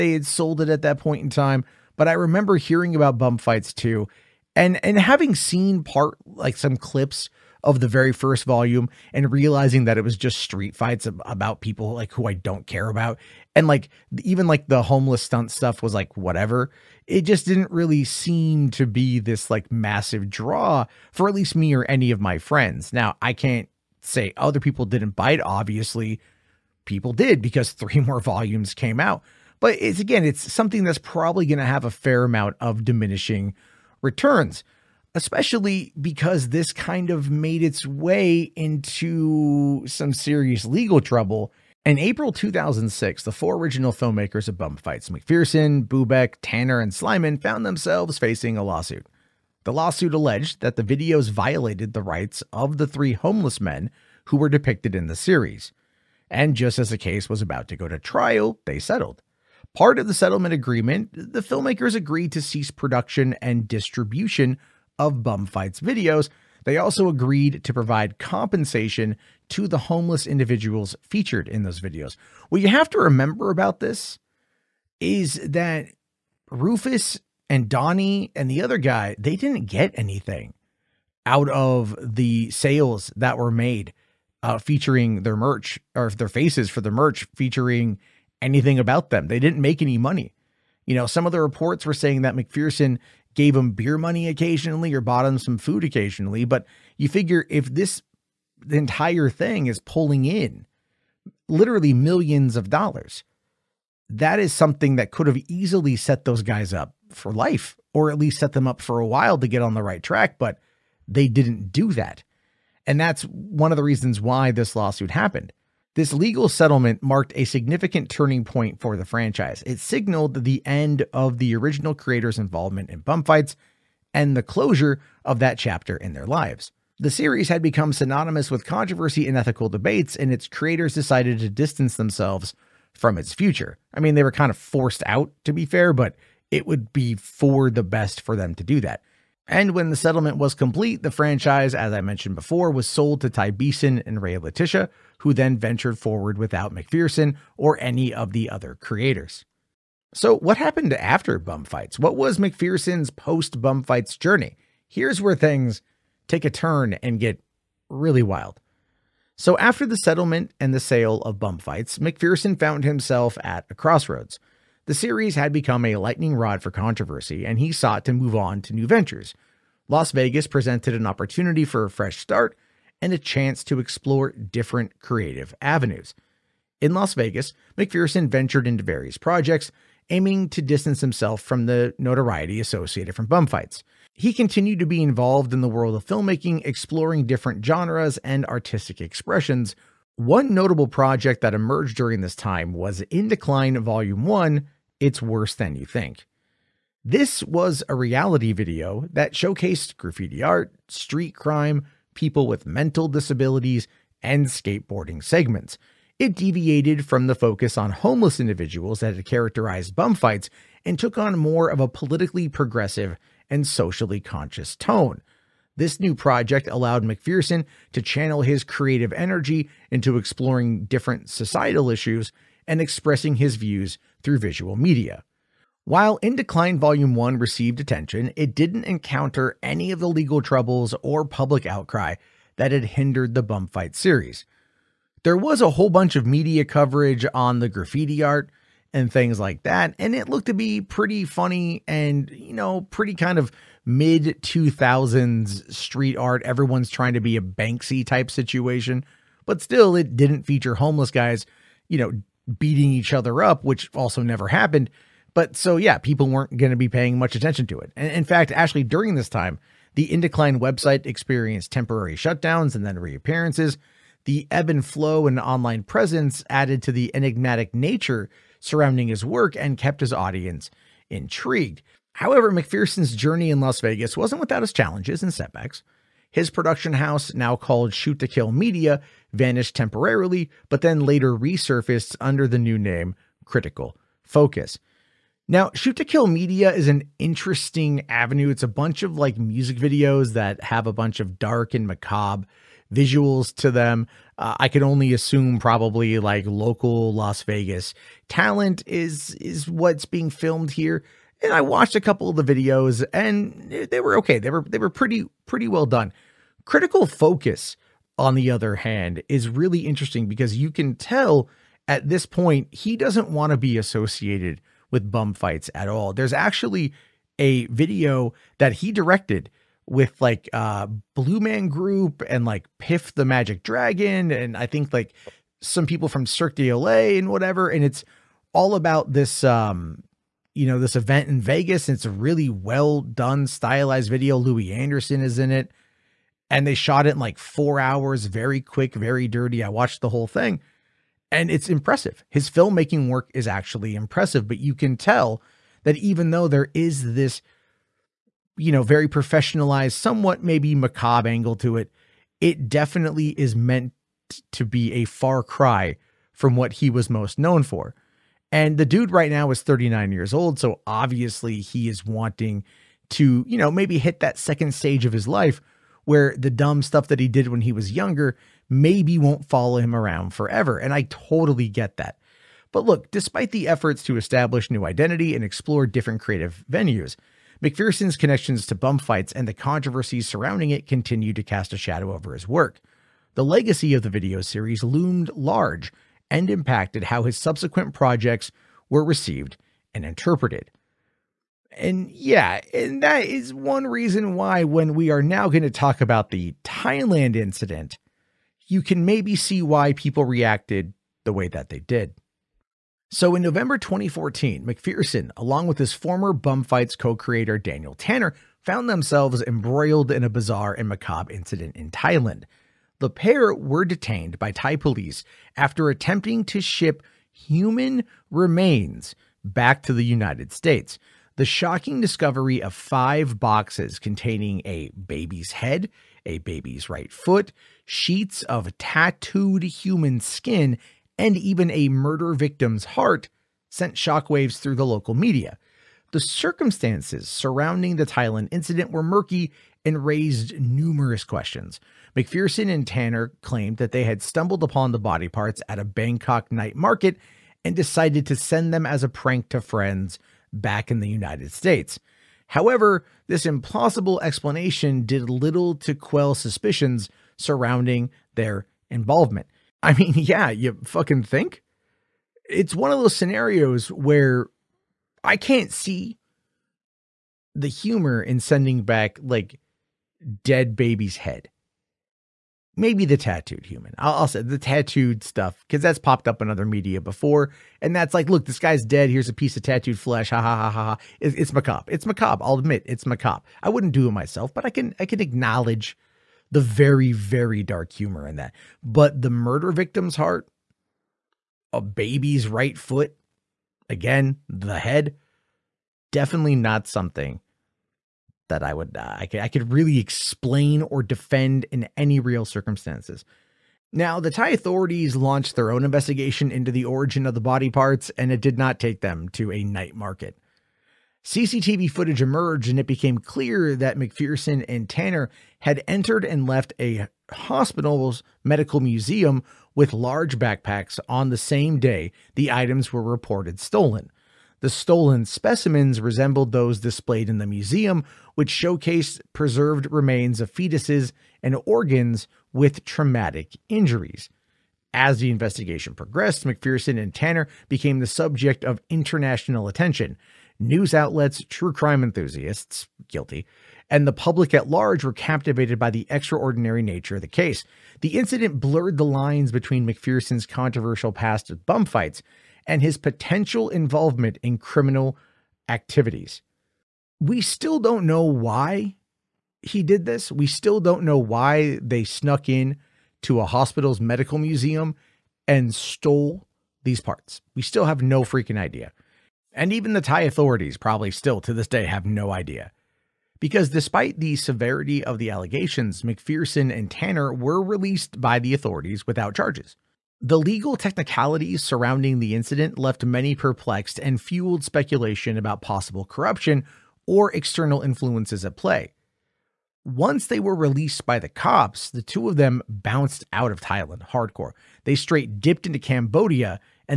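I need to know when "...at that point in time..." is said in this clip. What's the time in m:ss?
0:00.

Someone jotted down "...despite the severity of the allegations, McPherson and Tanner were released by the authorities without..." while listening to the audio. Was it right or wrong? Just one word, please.
right.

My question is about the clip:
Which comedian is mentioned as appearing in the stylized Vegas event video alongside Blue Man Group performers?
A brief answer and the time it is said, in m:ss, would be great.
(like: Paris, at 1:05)
Louie Anderson, at 5:34.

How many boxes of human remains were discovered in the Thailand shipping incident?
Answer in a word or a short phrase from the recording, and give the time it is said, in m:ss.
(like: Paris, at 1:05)
5, at 7:02.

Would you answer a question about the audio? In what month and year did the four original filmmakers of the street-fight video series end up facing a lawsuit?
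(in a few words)
April 2006.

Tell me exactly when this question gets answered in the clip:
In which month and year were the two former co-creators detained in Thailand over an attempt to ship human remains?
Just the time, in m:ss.
6:43.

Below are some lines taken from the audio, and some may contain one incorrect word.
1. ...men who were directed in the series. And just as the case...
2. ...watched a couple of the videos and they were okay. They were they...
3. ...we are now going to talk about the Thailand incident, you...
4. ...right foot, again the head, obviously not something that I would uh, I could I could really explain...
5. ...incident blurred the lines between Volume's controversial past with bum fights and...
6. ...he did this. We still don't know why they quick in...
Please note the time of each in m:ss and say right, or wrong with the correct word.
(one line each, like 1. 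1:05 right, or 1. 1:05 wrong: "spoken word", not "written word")
1. 0:53 wrong: "depicted", not "directed"
2. 5:01 right
3. 6:34 right
4. 8:12 wrong: "definitely", not "obviously"
5. 9:08 wrong: "McPherson", not "Volume"
6. 9:19 wrong: "snuck", not "quick".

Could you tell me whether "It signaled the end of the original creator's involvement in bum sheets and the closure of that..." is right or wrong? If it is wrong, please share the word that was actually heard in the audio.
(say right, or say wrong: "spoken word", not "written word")
wrong: "fights", not "sheets".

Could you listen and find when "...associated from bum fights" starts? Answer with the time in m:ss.
3:02.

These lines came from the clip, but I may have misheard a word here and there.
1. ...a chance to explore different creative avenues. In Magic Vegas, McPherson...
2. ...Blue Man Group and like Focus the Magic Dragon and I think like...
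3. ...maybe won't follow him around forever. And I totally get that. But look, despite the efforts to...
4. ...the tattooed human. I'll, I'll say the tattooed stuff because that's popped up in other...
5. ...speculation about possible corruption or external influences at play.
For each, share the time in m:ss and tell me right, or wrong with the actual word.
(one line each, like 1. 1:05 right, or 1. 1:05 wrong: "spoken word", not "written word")
1. 2:53 wrong: "Las", not "Magic"
2. 5:21 wrong: "Piff", not "Focus"
3. 6:08 right
4. 7:53 right
5. 9:44 right.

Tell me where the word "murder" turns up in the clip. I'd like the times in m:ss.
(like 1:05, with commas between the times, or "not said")
7:11, 8:09.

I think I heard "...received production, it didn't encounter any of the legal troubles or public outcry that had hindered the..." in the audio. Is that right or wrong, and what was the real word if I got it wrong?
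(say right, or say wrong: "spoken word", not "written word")
wrong: "attention", not "production".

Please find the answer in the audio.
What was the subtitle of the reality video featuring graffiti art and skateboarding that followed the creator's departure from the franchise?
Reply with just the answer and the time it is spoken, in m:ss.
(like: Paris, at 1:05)
It's Worse Than You Think, at 3:14.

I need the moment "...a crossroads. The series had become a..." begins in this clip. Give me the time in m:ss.
2:43.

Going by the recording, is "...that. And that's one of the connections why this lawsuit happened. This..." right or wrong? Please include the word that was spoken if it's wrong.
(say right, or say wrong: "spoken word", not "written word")
wrong: "reasons", not "connections".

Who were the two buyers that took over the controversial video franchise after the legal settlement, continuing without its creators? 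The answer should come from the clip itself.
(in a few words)
Ty Beeson and Ray Letitia.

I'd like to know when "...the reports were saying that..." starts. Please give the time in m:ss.
1:31.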